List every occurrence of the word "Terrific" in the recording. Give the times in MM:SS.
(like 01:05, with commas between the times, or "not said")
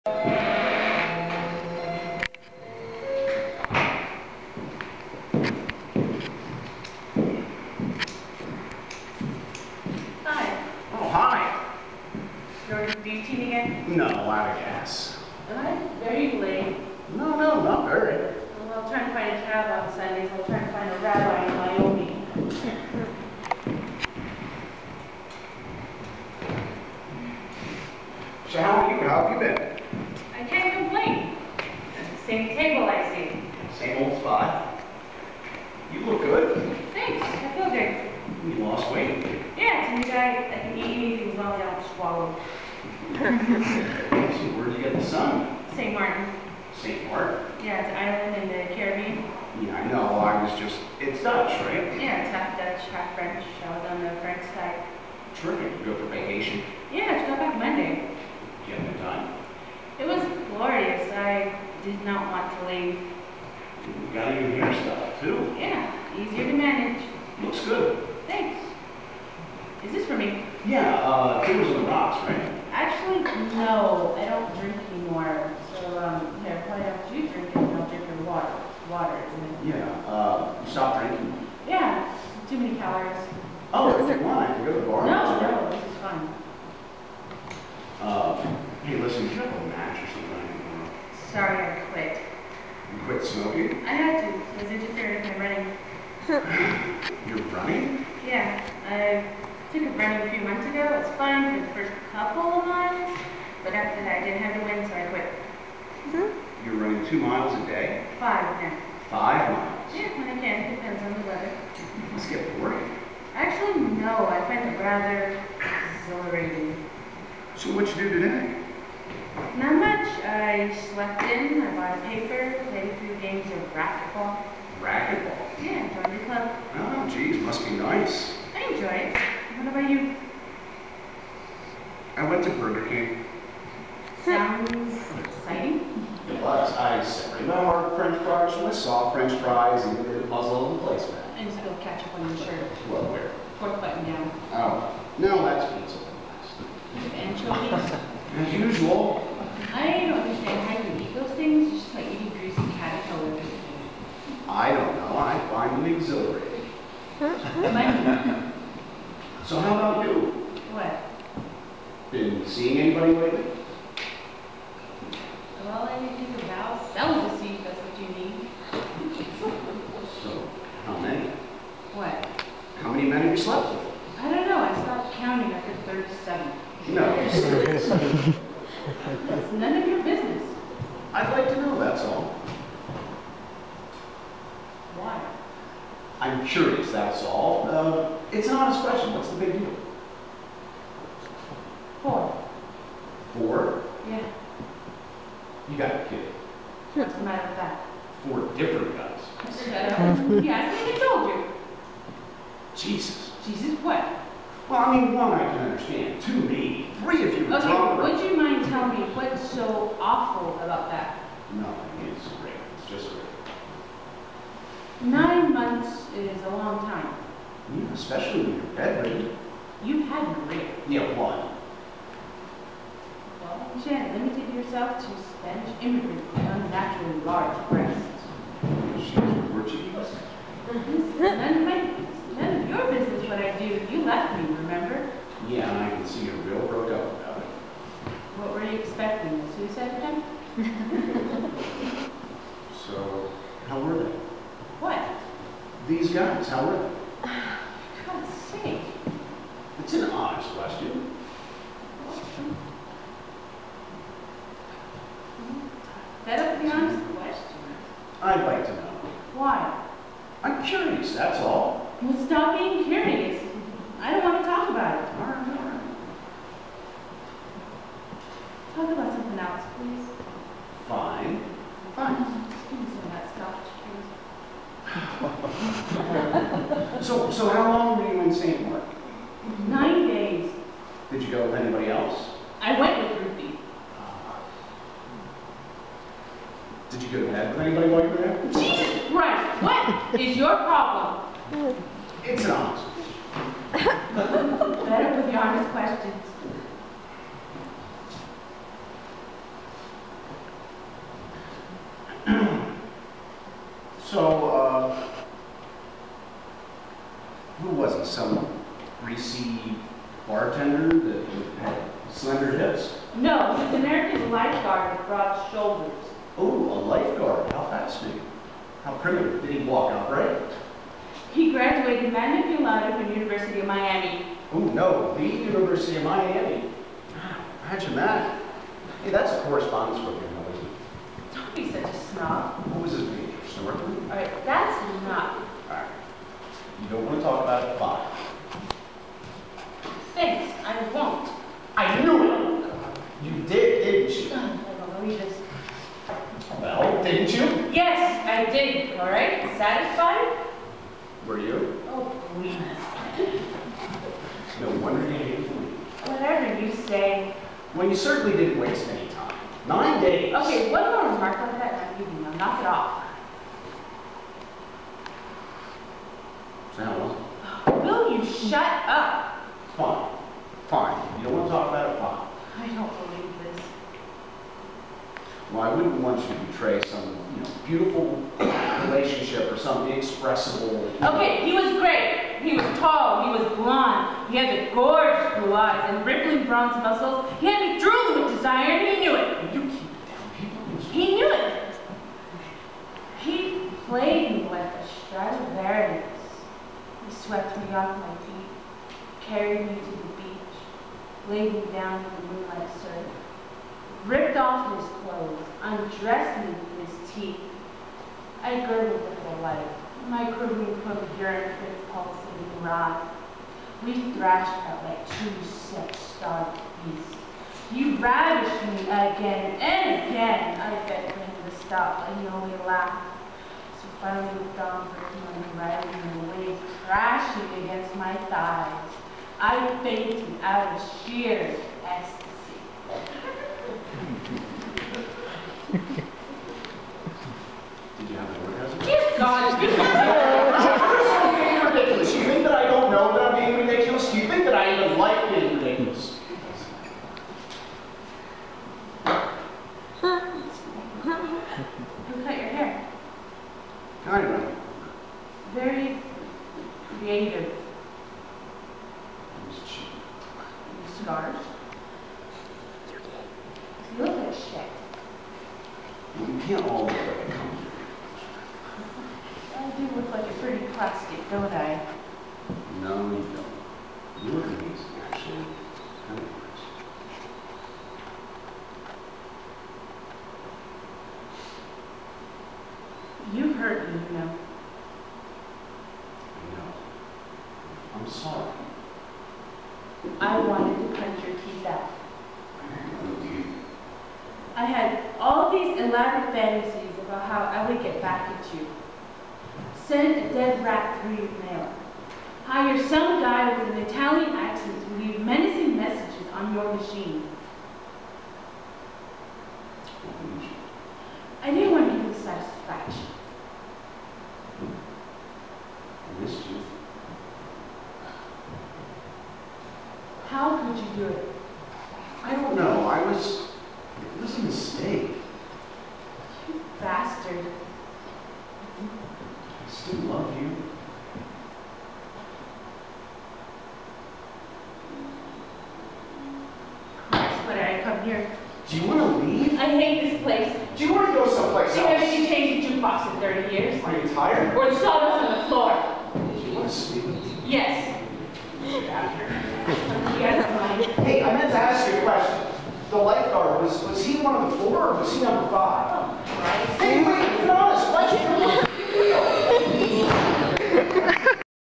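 00:55.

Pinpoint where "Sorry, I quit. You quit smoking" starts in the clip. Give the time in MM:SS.
01:31.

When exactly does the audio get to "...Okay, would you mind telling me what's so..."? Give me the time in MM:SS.
03:27.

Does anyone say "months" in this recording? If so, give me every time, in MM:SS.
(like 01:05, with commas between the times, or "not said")
01:40, 03:35.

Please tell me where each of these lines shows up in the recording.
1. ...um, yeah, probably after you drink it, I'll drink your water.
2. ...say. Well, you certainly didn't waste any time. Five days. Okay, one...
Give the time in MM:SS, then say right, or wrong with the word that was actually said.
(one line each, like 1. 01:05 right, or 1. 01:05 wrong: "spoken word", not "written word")
1. 01:15 right
2. 05:56 wrong: "Nine", not "Five".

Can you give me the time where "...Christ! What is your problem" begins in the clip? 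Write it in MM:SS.
04:49.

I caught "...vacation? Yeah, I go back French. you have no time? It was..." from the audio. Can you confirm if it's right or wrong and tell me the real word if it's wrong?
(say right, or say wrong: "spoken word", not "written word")
wrong: "Monday", not "French".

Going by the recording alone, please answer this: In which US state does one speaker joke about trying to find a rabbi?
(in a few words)
Wyoming.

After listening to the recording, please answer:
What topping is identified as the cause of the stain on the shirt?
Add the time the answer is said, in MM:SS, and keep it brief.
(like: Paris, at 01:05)
Anchovies, at 02:27.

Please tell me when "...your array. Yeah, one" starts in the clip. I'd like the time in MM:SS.
03:40.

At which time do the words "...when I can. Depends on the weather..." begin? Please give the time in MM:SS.
01:50.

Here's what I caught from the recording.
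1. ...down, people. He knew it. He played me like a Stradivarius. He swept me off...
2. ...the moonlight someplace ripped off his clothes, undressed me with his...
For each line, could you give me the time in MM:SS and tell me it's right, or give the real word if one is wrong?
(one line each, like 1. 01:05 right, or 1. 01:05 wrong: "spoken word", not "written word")
1. 06:30 right
2. 06:42 wrong: "surface", not "someplace".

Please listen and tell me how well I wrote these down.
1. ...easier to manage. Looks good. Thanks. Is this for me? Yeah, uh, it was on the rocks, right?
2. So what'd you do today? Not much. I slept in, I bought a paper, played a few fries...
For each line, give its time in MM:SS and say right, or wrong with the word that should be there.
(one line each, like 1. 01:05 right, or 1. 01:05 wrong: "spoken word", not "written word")
1. 01:06 right
2. 01:57 wrong: "games", not "fries".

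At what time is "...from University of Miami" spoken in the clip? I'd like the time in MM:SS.
05:23.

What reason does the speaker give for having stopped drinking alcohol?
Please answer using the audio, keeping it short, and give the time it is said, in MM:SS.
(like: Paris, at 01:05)
Too many calories, at 01:22.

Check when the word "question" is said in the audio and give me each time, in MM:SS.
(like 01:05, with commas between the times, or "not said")
03:08, 04:10, 04:17, 04:55, 09:12.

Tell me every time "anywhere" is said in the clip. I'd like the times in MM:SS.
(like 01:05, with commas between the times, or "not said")
not said.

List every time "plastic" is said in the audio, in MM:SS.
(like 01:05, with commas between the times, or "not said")
07:50.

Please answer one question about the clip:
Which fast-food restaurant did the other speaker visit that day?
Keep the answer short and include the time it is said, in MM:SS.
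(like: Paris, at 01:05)
Burger King, at 02:12.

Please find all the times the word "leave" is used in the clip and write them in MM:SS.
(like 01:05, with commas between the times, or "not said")
01:02, 08:25, 08:59.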